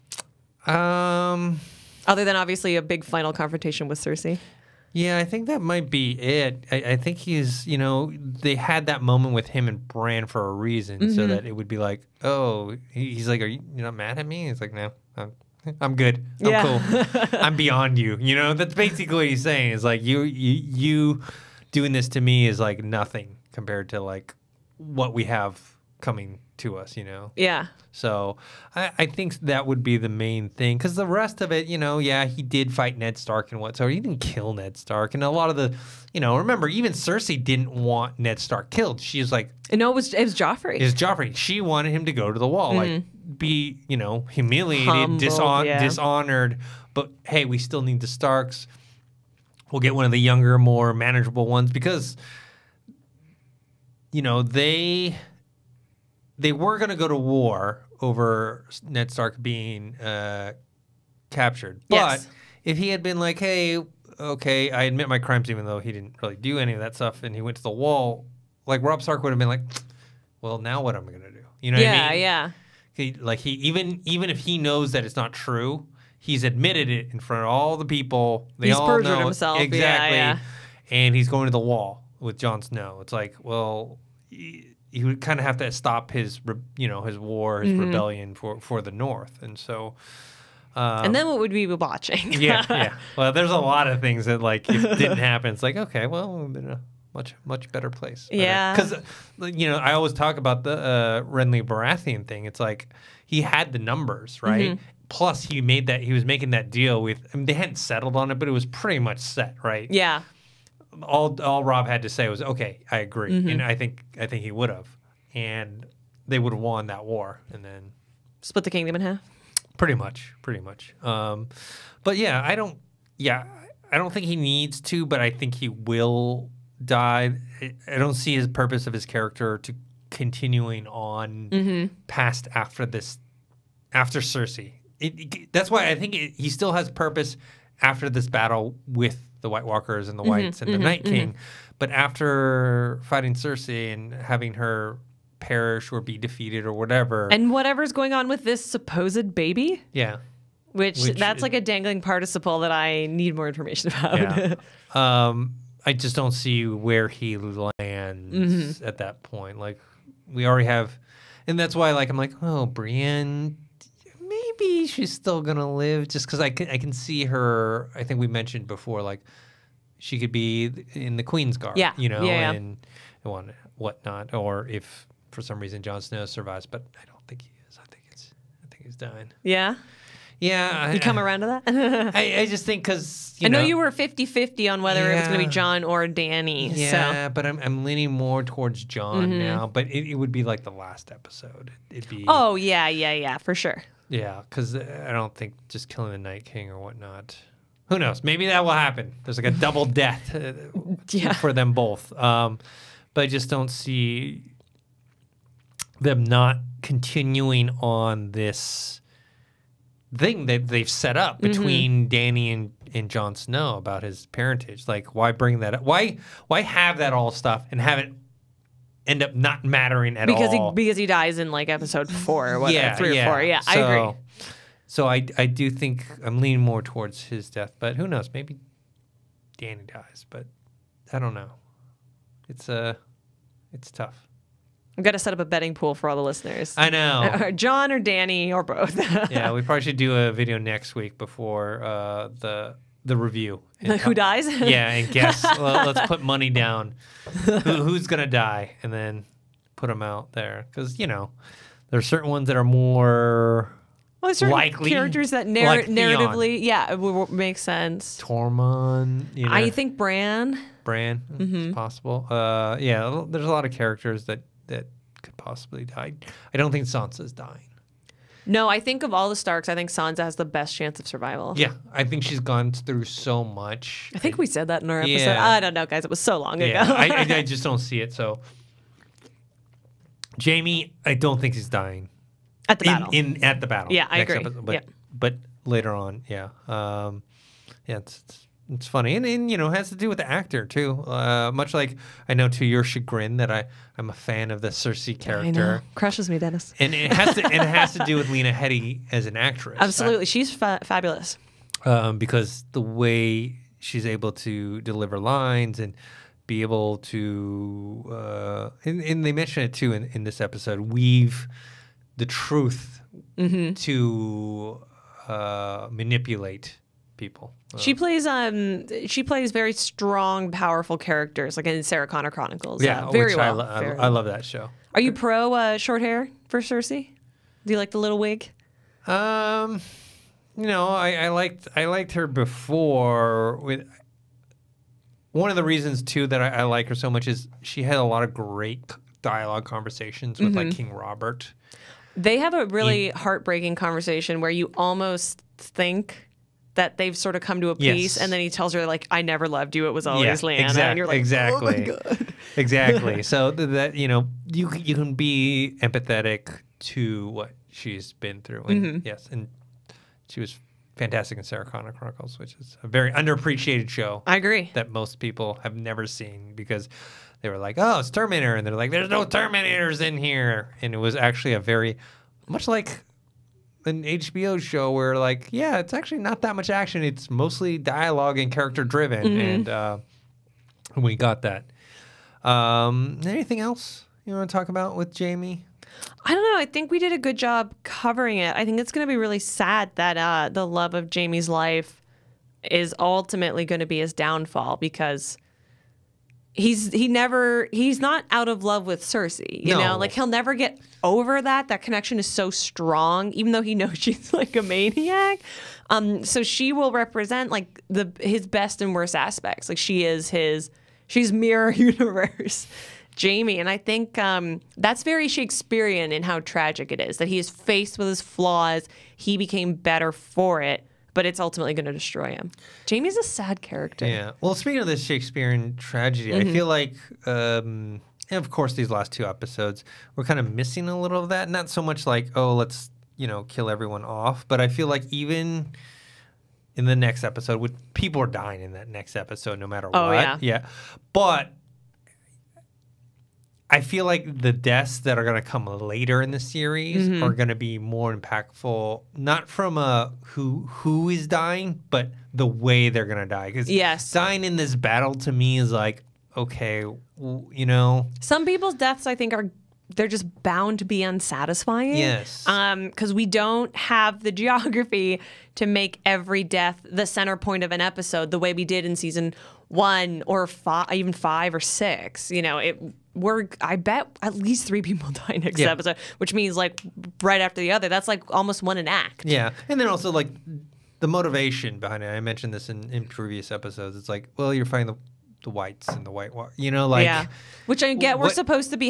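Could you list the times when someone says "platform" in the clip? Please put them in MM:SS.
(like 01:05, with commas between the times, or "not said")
not said.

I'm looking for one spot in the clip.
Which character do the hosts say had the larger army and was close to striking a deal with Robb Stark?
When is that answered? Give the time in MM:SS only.
01:41.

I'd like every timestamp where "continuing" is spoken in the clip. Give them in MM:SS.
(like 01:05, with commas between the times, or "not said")
02:10, 03:26.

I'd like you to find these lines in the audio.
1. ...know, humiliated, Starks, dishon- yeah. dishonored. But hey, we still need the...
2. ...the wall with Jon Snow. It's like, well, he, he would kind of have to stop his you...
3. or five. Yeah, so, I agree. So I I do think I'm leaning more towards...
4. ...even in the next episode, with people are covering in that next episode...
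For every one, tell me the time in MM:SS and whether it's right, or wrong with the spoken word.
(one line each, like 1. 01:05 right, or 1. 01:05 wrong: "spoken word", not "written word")
1. 00:43 wrong: "Humbled", not "Starks"
2. 01:21 right
3. 03:43 wrong: "four", not "five"
4. 07:15 wrong: "dying", not "covering".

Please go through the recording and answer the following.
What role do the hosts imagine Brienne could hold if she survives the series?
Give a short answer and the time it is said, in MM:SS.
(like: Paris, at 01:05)
Queen's Guard, at 02:51.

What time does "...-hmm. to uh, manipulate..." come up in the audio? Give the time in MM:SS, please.
05:13.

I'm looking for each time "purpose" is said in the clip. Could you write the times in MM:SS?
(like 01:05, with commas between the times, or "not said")
02:08, 02:16.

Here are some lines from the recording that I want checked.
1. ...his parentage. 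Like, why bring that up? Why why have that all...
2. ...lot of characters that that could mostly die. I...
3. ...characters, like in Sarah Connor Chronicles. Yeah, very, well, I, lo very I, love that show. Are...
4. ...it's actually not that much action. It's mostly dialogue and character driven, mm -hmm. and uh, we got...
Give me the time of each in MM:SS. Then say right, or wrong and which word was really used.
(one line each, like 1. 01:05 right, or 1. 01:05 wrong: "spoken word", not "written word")
1. 03:34 right
2. 04:23 wrong: "possibly", not "mostly"
3. 05:20 right
4. 06:15 right.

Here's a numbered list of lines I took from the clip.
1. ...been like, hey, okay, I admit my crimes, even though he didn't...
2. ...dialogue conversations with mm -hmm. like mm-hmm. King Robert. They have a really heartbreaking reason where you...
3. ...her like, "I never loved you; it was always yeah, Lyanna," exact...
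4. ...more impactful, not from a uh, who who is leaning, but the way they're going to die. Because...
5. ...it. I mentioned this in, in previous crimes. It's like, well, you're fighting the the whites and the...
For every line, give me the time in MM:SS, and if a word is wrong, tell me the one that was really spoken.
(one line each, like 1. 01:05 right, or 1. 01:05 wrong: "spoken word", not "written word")
1. 01:03 right
2. 05:39 wrong: "conversation", not "reason"
3. 05:48 right
4. 07:27 wrong: "dying", not "leaning"
5. 08:02 wrong: "episodes", not "crimes".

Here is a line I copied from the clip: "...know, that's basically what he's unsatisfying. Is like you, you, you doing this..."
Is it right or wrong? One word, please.
wrong.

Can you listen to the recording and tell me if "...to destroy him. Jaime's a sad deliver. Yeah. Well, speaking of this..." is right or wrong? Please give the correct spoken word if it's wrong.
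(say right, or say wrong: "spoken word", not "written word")
wrong: "character", not "deliver".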